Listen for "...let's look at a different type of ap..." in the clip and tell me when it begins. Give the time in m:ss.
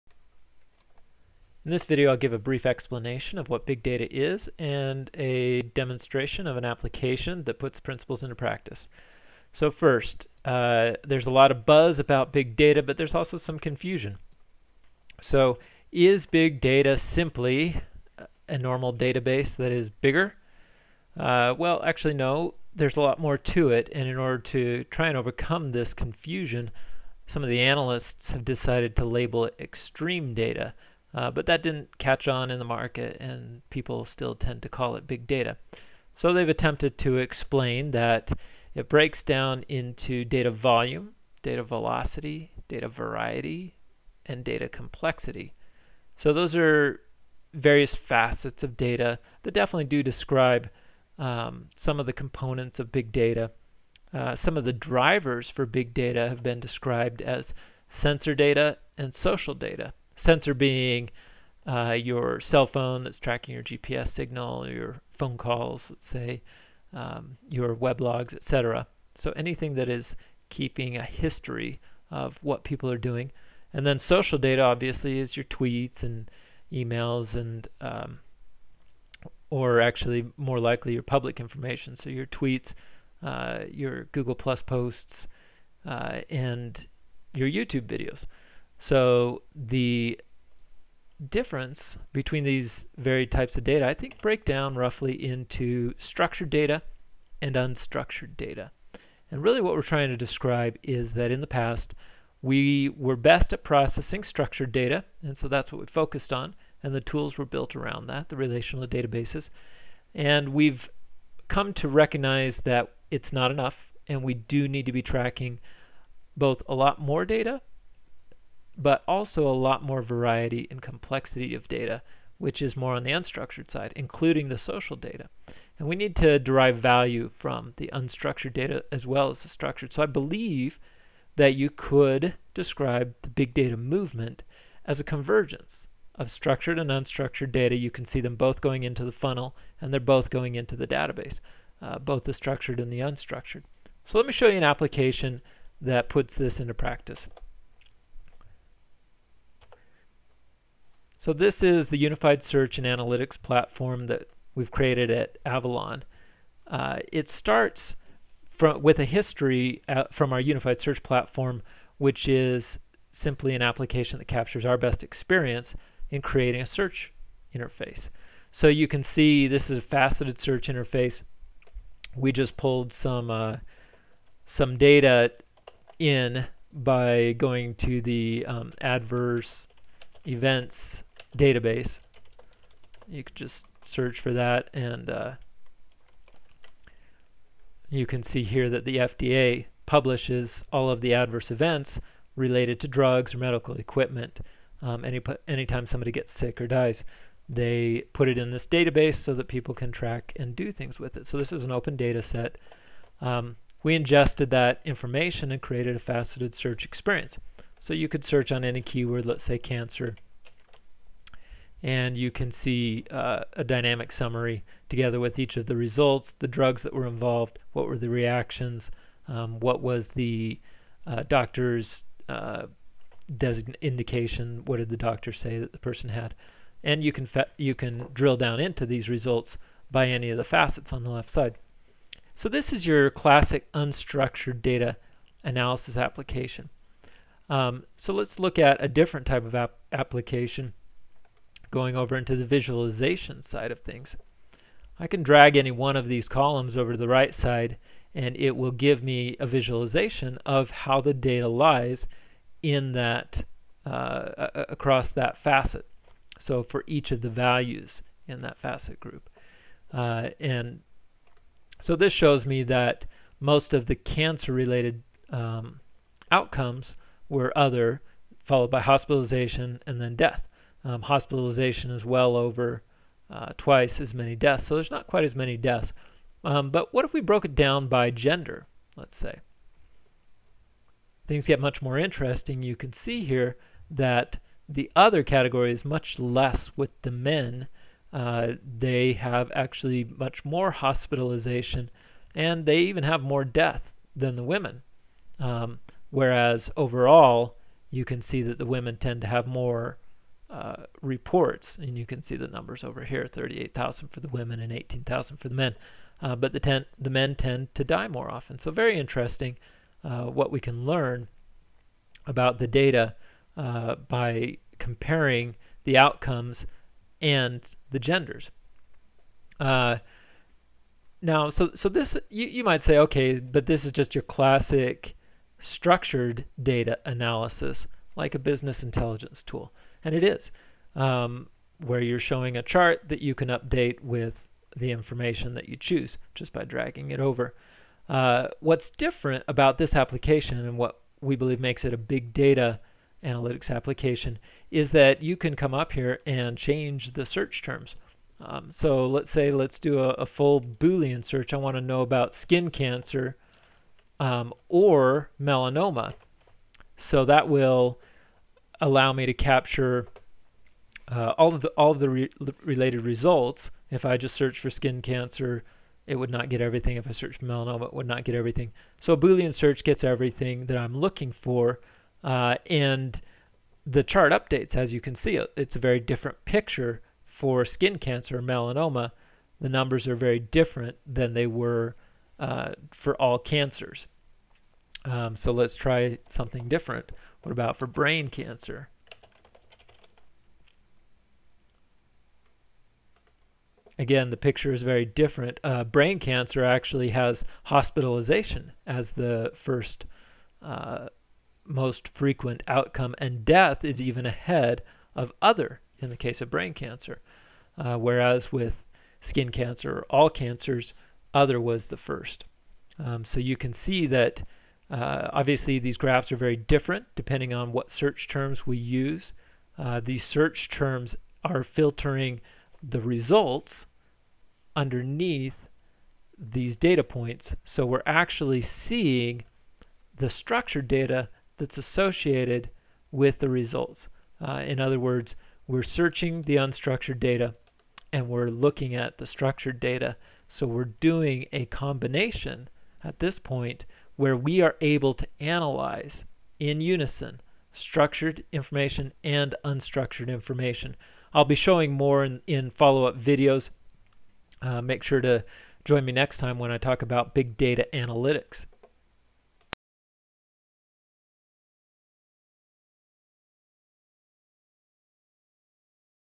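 3:58.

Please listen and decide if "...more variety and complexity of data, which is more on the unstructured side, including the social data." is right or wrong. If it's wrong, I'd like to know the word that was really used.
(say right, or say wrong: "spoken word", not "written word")
right.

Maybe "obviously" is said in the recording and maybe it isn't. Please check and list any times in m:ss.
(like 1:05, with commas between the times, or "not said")
1:14, 6:55.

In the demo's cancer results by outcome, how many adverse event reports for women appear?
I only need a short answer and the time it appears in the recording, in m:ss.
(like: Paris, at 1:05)
38,000, at 5:03.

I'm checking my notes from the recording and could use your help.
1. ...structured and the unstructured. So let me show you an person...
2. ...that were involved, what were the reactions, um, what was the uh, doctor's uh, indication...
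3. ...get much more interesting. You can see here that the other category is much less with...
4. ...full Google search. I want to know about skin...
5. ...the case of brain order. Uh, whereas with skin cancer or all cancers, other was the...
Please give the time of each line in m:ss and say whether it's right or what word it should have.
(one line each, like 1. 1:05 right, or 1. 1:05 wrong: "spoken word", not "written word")
1. 2:22 wrong: "application", not "person"
2. 3:36 right
3. 4:41 right
4. 5:50 wrong: "Boolean", not "Google"
5. 6:46 wrong: "cancer", not "order".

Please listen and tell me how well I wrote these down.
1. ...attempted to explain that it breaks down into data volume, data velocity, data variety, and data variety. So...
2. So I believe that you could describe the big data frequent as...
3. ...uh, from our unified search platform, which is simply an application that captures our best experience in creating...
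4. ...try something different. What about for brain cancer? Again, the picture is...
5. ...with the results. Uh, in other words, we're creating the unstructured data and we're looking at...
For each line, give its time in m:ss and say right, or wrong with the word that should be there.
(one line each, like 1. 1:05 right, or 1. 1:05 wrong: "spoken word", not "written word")
1. 0:36 wrong: "complexity", not "variety"
2. 2:09 wrong: "movement", not "frequent"
3. 2:39 right
4. 6:25 right
5. 7:13 wrong: "searching", not "creating".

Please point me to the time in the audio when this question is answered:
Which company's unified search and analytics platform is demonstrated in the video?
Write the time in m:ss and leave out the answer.
2:35.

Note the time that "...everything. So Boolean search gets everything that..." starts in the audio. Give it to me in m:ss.
6:08.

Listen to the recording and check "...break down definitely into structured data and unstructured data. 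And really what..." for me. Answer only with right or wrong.
wrong.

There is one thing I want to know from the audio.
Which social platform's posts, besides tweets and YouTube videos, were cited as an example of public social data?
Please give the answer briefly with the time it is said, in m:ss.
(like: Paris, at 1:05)
Google Plus, at 1:24.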